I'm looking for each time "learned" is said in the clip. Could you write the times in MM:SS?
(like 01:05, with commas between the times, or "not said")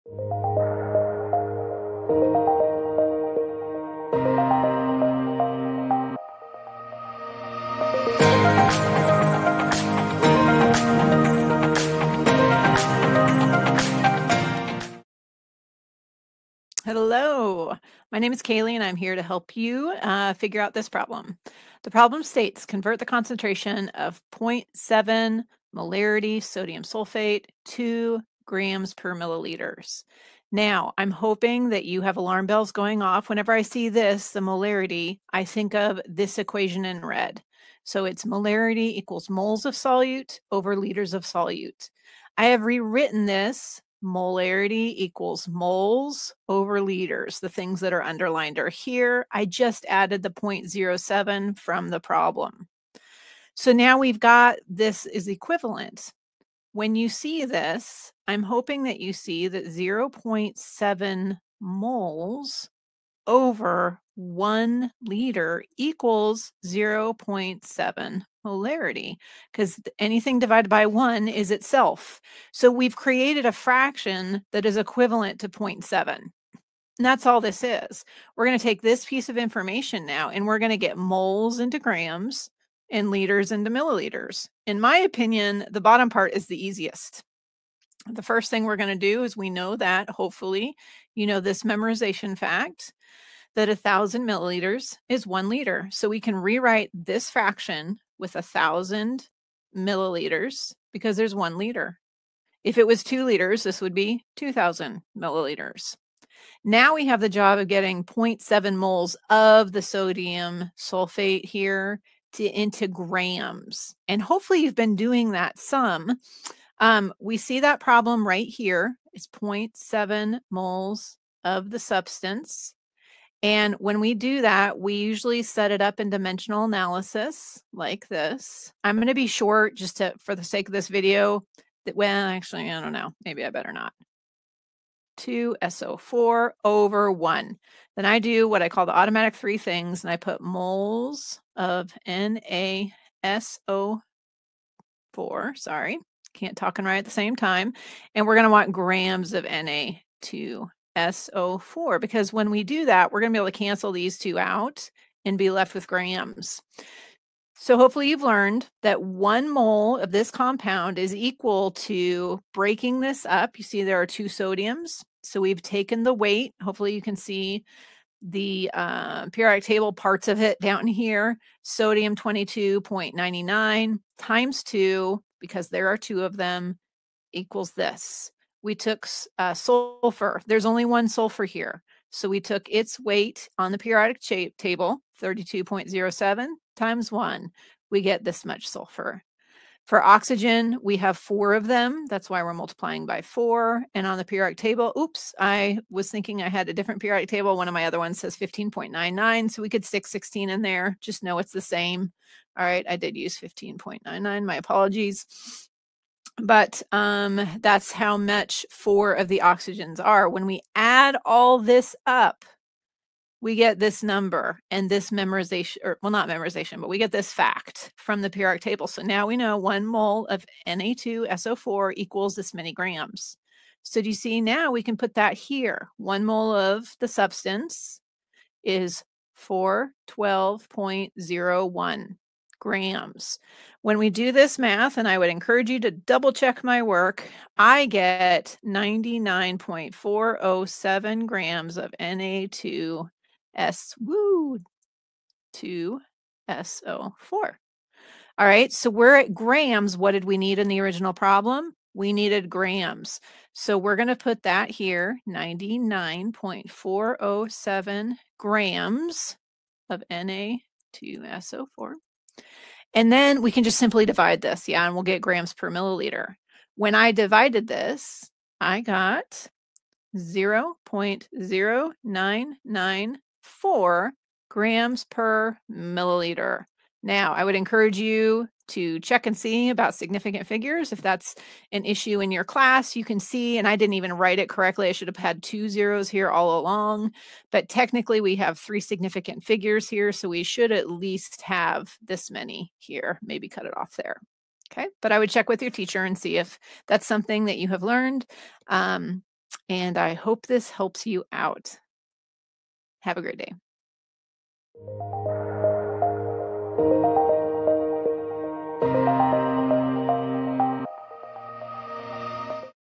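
02:38, 04:57.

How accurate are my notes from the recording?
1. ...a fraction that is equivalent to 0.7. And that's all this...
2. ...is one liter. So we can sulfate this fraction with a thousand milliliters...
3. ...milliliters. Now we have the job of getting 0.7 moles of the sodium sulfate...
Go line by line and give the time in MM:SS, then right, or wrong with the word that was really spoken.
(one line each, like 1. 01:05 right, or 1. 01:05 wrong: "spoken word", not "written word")
1. 01:13 right
2. 01:35 wrong: "rewrite", not "sulfate"
3. 01:45 right.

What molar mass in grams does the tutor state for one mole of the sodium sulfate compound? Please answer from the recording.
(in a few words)
412.01 grams.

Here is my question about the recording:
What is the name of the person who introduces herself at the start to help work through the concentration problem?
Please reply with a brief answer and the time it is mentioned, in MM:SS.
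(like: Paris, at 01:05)
Kaele, at 00:18.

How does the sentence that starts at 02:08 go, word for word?
I'm going to be short just to, for the sake of this video.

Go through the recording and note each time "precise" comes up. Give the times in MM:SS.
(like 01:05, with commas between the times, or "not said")
not said.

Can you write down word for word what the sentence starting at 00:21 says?
The problem states convert the concentration of 0.7 molarity sodium sulfate to grams per milliliters.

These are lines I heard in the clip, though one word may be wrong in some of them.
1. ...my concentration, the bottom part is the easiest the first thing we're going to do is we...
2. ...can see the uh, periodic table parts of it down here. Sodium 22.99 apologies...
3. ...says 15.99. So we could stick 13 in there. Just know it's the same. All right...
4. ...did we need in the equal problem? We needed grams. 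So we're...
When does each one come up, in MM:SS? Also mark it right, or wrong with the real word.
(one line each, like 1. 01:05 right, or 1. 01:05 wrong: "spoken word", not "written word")
1. 01:24 wrong: "opinion", not "concentration"
2. 02:47 wrong: "times", not "apologies"
3. 03:18 wrong: "16", not "13"
4. 04:10 wrong: "original", not "equal".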